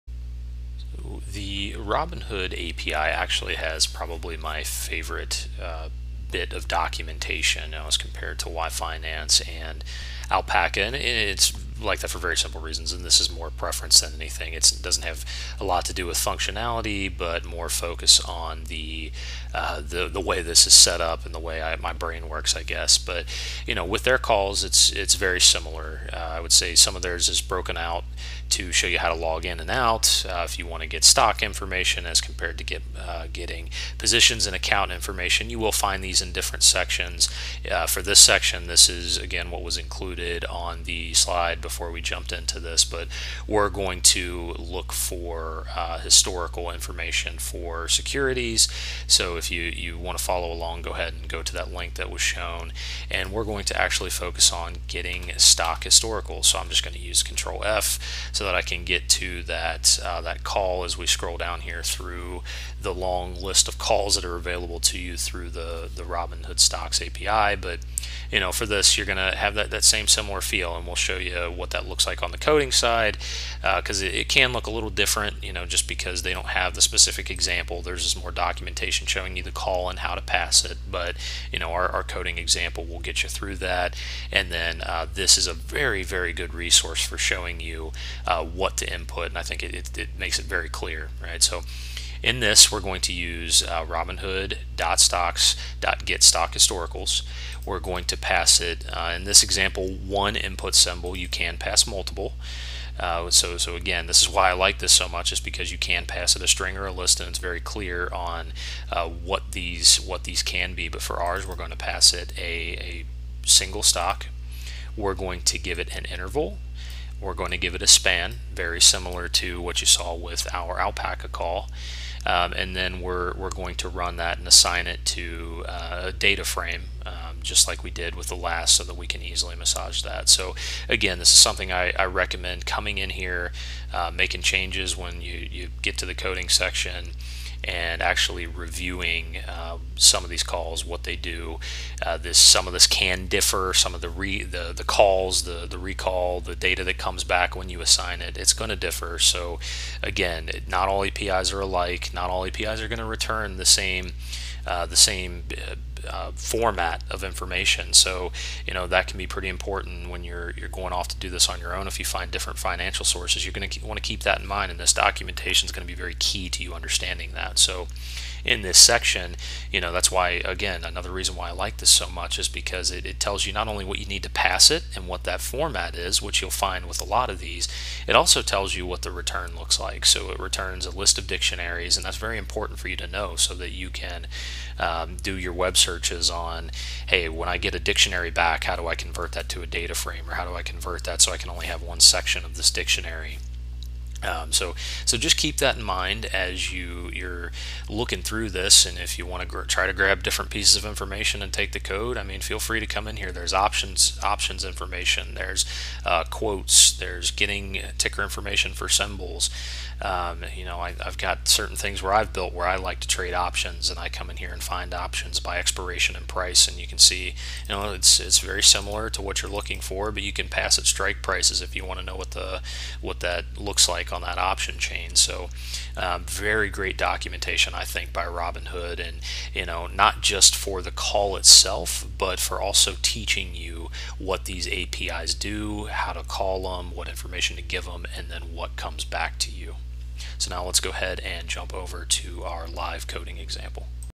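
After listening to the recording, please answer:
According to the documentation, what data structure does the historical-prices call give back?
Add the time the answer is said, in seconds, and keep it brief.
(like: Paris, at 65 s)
A list of dictionaries, at 180 s.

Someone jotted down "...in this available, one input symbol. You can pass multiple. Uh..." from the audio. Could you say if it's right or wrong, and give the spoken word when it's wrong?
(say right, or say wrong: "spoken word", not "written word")
wrong: "example", not "available".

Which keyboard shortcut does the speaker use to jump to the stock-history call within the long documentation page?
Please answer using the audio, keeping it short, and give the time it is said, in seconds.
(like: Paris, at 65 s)
Control F, at 57 s.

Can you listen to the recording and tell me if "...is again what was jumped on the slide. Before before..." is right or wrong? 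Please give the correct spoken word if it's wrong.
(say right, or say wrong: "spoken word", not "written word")
wrong: "included", not "jumped".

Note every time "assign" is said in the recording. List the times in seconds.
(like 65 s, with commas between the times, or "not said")
124 s, 147 s.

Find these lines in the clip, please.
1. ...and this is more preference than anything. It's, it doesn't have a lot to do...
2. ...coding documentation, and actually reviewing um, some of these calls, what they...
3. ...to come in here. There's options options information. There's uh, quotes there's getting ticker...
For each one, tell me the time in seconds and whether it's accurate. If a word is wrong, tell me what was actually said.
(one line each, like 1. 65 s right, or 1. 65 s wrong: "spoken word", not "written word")
1. 12 s right
2. 136 s wrong: "section", not "documentation"
3. 202 s right.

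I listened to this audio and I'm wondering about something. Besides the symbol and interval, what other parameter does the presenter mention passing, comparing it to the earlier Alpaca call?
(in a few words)
span.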